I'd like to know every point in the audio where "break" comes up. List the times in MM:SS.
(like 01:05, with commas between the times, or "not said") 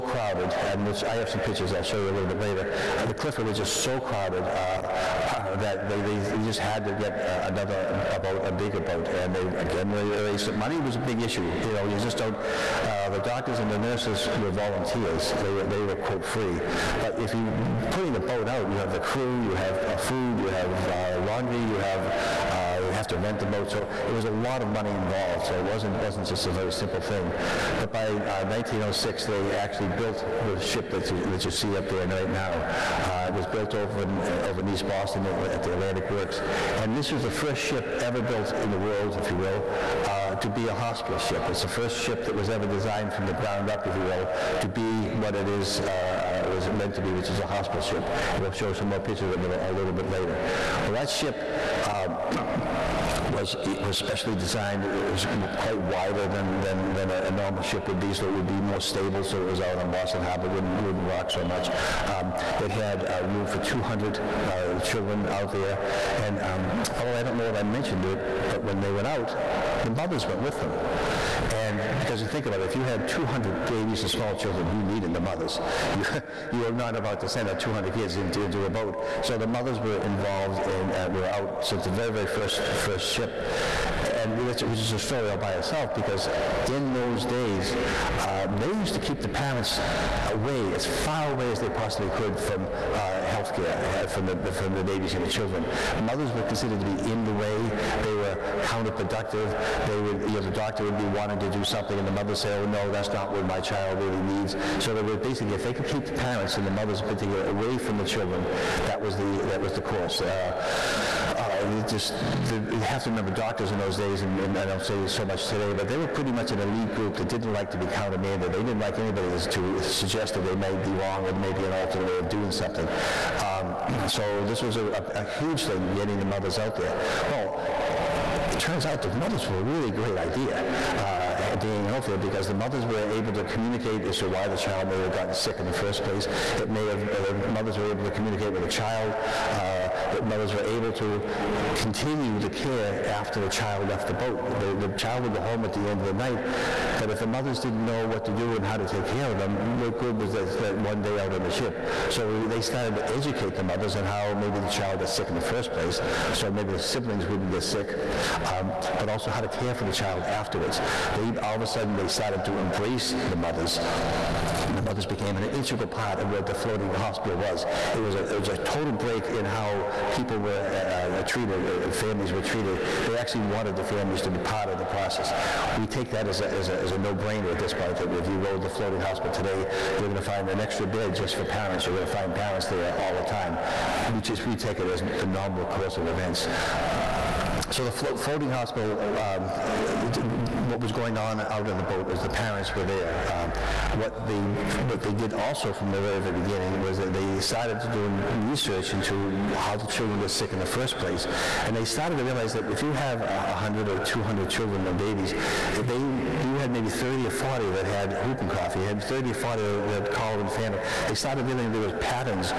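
02:48.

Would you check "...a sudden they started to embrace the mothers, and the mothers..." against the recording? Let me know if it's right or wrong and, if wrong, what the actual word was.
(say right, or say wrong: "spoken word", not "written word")
right.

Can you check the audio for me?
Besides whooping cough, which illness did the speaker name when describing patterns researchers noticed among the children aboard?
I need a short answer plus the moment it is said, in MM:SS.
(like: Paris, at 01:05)
cholera infantum, at 03:30.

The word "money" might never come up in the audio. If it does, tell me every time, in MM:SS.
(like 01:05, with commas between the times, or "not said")
00:10, 00:24.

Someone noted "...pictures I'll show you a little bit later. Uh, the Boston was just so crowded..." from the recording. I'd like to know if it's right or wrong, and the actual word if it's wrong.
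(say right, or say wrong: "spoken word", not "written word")
wrong: "Clifford", not "Boston".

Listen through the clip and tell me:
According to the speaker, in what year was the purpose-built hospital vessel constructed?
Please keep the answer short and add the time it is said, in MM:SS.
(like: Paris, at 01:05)
1906, at 00:28.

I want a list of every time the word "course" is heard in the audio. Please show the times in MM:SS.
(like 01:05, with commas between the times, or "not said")
01:49, 03:05.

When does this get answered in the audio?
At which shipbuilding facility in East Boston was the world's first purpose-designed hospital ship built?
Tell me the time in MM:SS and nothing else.
00:35.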